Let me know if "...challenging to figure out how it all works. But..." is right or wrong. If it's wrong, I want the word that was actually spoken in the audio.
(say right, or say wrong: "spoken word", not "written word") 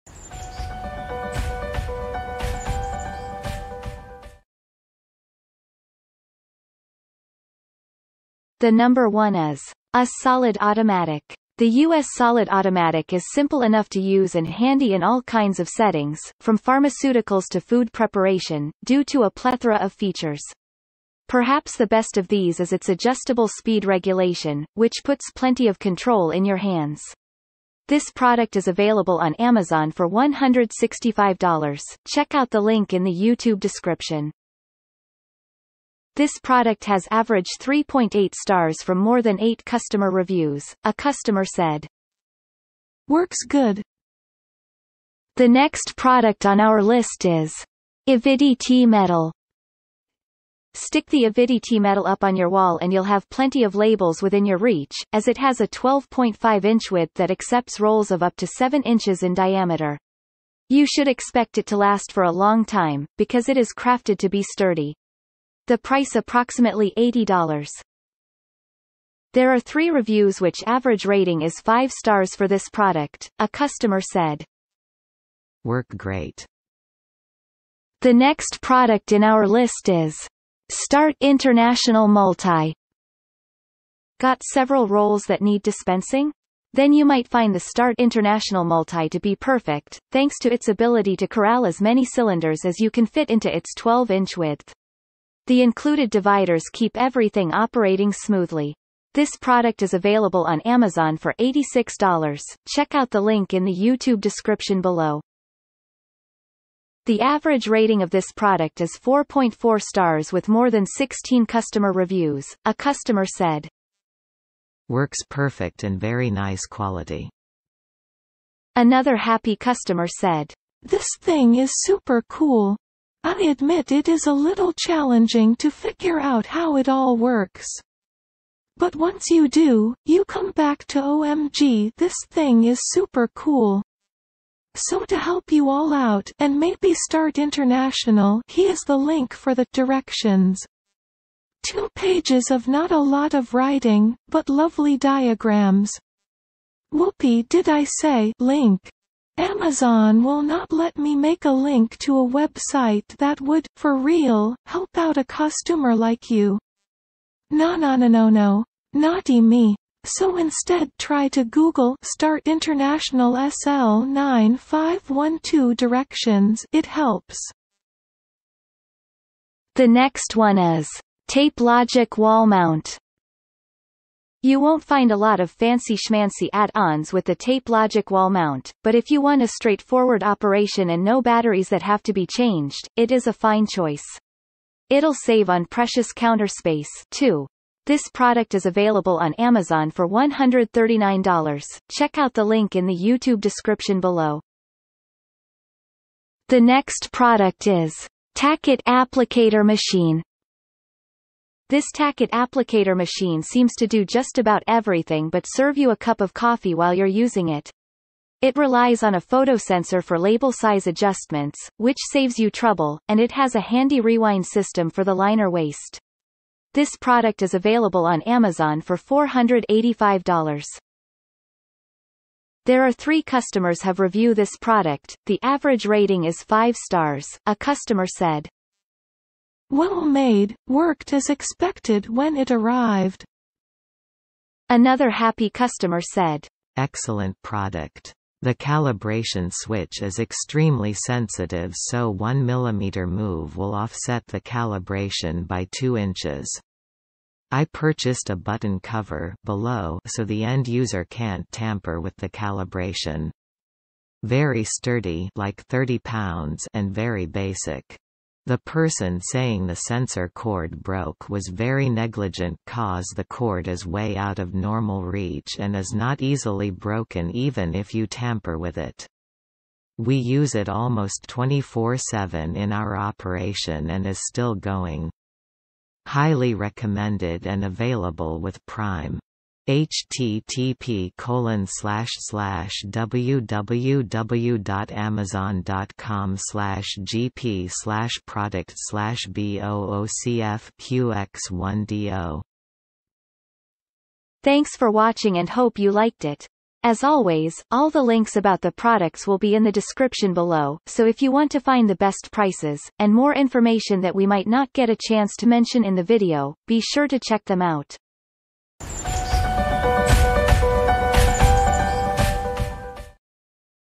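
right.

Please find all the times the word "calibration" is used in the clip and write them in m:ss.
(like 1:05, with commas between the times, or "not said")
3:58, 4:04, 4:12.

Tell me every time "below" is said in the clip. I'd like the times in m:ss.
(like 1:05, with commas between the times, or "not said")
1:44, 3:13, 4:09, 5:00.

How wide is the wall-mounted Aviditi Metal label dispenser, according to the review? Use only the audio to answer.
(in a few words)
12.5 inches.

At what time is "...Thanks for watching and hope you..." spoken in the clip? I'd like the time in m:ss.
4:54.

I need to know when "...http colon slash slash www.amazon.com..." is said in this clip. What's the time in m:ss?
4:39.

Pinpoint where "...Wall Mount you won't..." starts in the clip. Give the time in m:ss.
2:52.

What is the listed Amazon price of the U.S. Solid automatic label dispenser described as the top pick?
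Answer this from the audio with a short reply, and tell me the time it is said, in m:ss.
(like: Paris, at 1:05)
$165, at 0:30.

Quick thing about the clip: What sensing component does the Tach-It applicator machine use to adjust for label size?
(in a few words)
photosensor.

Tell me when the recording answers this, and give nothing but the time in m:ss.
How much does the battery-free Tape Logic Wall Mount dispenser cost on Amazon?
3:10.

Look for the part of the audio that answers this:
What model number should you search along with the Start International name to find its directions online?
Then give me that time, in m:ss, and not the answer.
2:43.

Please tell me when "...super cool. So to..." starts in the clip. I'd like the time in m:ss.
2:12.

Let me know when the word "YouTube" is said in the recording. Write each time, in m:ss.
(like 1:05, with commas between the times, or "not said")
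0:33, 1:43, 3:12.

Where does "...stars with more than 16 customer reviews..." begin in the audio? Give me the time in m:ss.
1:49.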